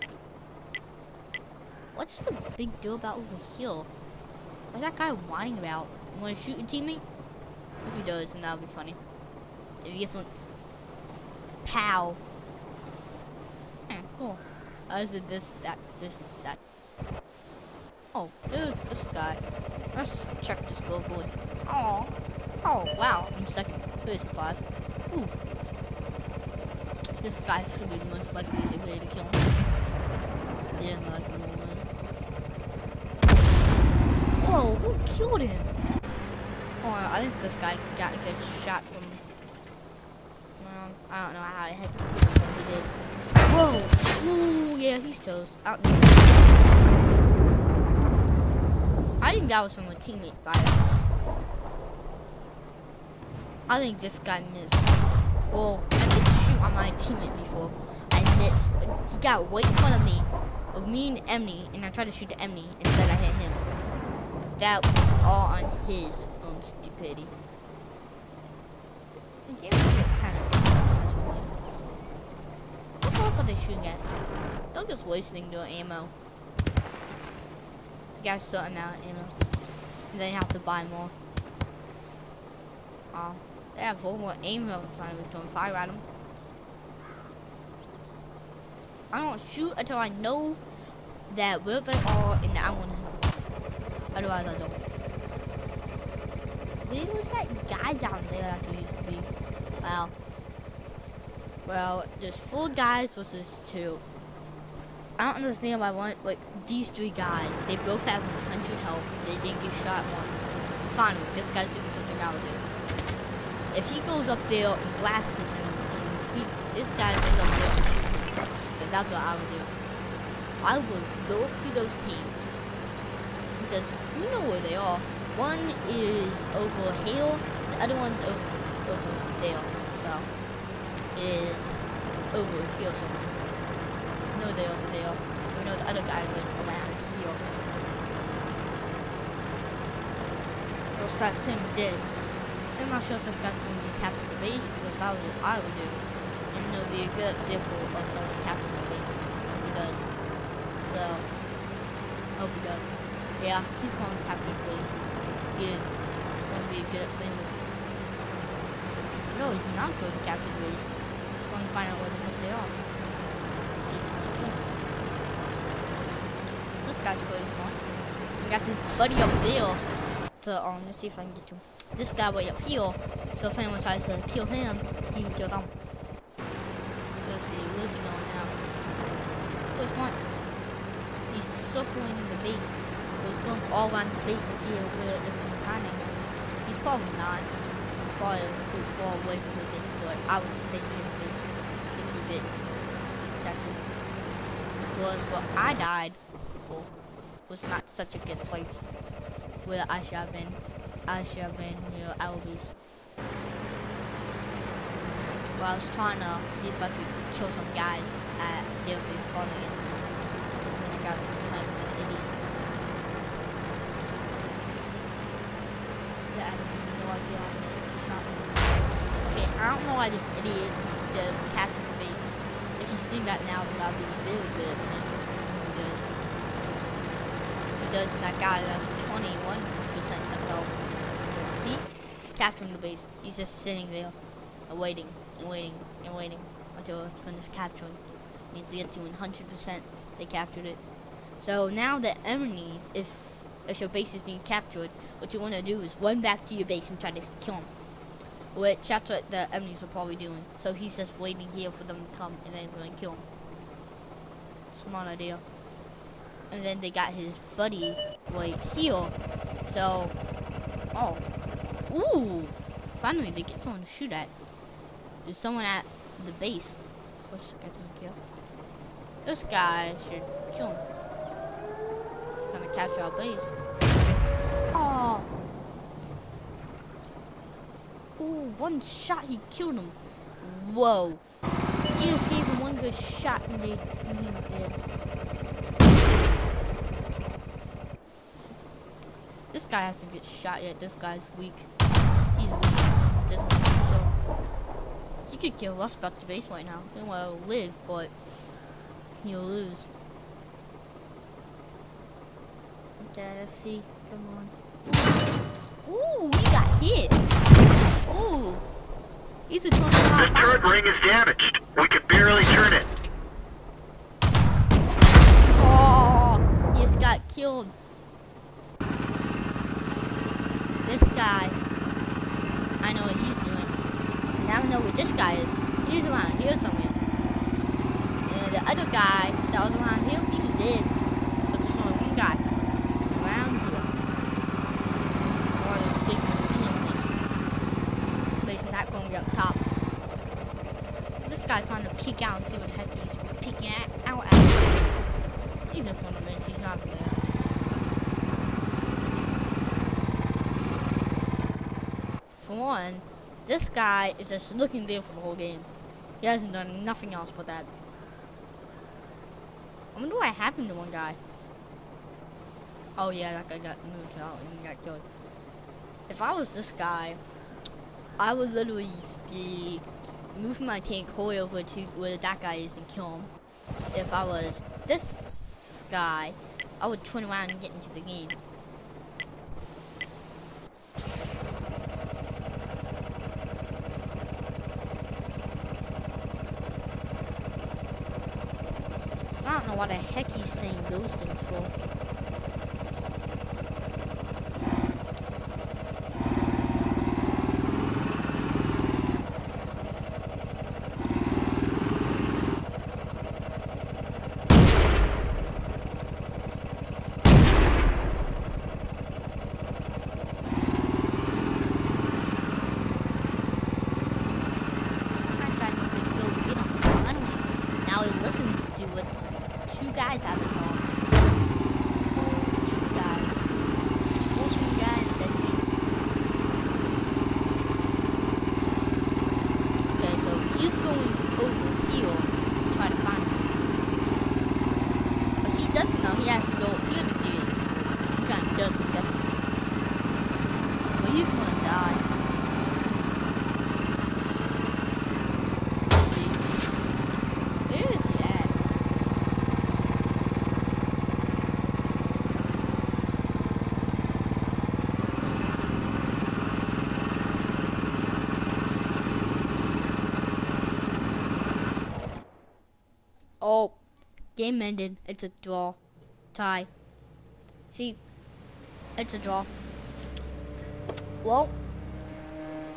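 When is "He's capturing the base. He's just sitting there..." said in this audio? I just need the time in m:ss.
3:52.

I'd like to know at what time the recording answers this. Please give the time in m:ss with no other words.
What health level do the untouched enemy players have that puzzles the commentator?
1:48.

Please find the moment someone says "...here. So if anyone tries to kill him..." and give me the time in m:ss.
2:52.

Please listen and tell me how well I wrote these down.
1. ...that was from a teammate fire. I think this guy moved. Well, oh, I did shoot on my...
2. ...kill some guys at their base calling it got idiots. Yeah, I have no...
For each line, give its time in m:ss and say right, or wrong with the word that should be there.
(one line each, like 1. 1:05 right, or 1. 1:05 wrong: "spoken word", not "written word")
1. 0:49 wrong: "missed", not "moved"
2. 3:27 right.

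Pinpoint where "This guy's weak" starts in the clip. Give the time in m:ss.
4:50.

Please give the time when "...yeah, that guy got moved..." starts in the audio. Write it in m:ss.
6:03.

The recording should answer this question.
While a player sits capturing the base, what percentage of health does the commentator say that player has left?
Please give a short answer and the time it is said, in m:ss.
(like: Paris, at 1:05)
21%, at 3:49.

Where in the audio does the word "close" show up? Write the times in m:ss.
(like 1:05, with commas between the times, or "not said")
2:47, 2:59.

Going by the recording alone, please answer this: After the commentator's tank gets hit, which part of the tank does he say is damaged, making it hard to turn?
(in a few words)
turret ring.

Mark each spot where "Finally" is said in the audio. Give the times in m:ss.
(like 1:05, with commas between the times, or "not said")
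1:50, 4:22.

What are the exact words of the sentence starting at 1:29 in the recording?
I don't shoot until I know that where they are and I'm to Otherwise, I don't.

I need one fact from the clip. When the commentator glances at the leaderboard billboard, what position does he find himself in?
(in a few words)
second.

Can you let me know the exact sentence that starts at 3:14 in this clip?
Because what I died well, was not such a good place where I should have been.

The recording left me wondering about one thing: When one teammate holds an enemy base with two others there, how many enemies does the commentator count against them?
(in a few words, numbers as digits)
4.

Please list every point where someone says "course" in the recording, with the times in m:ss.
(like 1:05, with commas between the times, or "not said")
4:27.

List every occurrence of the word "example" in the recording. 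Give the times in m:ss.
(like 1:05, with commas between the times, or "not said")
2:27, 2:37.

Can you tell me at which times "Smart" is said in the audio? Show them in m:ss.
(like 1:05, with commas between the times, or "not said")
4:14.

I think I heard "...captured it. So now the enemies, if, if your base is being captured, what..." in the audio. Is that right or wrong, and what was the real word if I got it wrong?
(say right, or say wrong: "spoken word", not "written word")
right.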